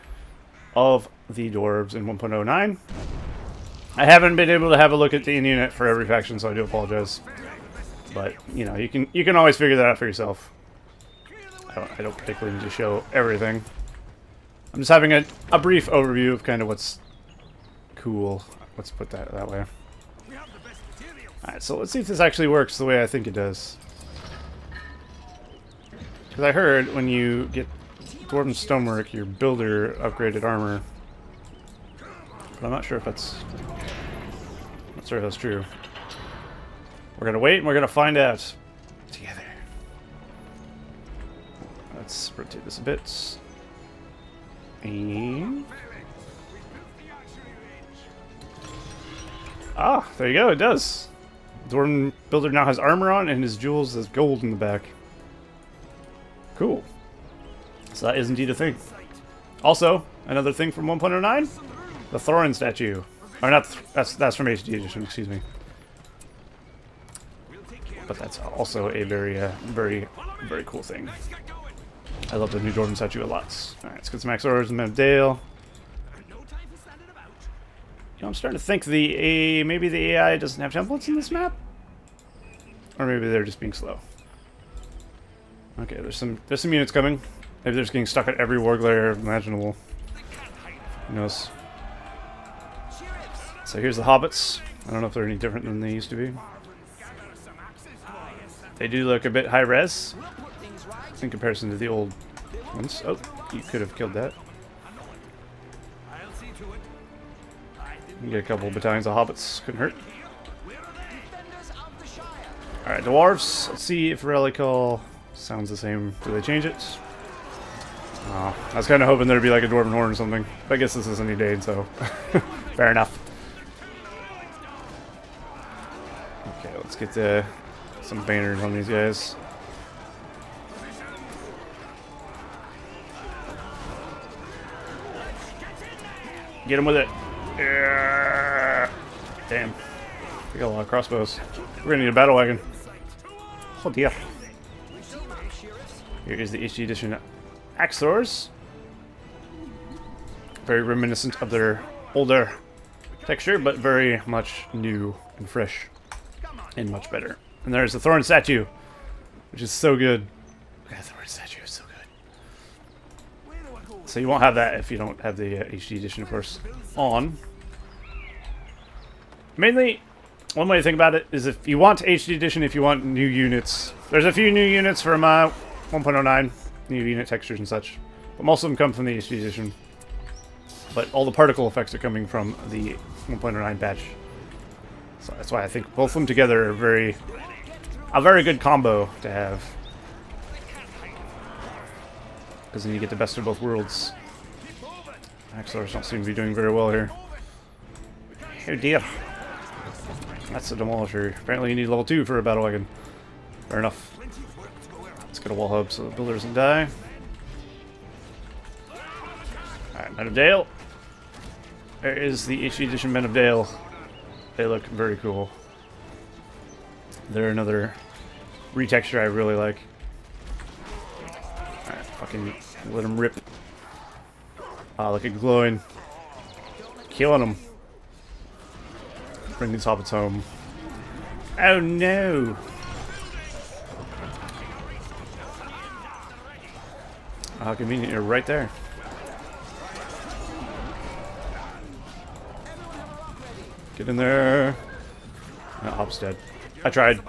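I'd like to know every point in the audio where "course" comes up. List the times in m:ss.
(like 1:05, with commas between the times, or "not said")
2:46.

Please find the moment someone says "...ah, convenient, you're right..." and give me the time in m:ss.
3:57.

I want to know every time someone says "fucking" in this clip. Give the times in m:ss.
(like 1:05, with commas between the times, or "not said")
3:42.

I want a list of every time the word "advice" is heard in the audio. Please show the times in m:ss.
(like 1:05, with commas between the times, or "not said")
not said.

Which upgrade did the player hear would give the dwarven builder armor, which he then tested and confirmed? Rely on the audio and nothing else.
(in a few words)
Dwarven Stonework.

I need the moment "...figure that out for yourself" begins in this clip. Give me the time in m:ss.
0:09.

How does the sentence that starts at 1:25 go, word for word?
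Okay, there's some there's some units coming.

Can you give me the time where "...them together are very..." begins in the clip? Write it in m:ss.
3:06.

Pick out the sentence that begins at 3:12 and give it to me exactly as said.
Because then you get the best of both worlds.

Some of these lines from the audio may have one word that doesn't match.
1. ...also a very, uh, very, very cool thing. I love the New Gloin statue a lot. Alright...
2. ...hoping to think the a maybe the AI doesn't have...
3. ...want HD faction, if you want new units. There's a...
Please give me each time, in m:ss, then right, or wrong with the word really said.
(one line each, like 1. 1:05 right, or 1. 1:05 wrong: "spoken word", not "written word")
1. 1:08 wrong: "Jordan", not "Gloin"
2. 1:18 wrong: "starting", not "hoping"
3. 2:51 wrong: "edition", not "faction".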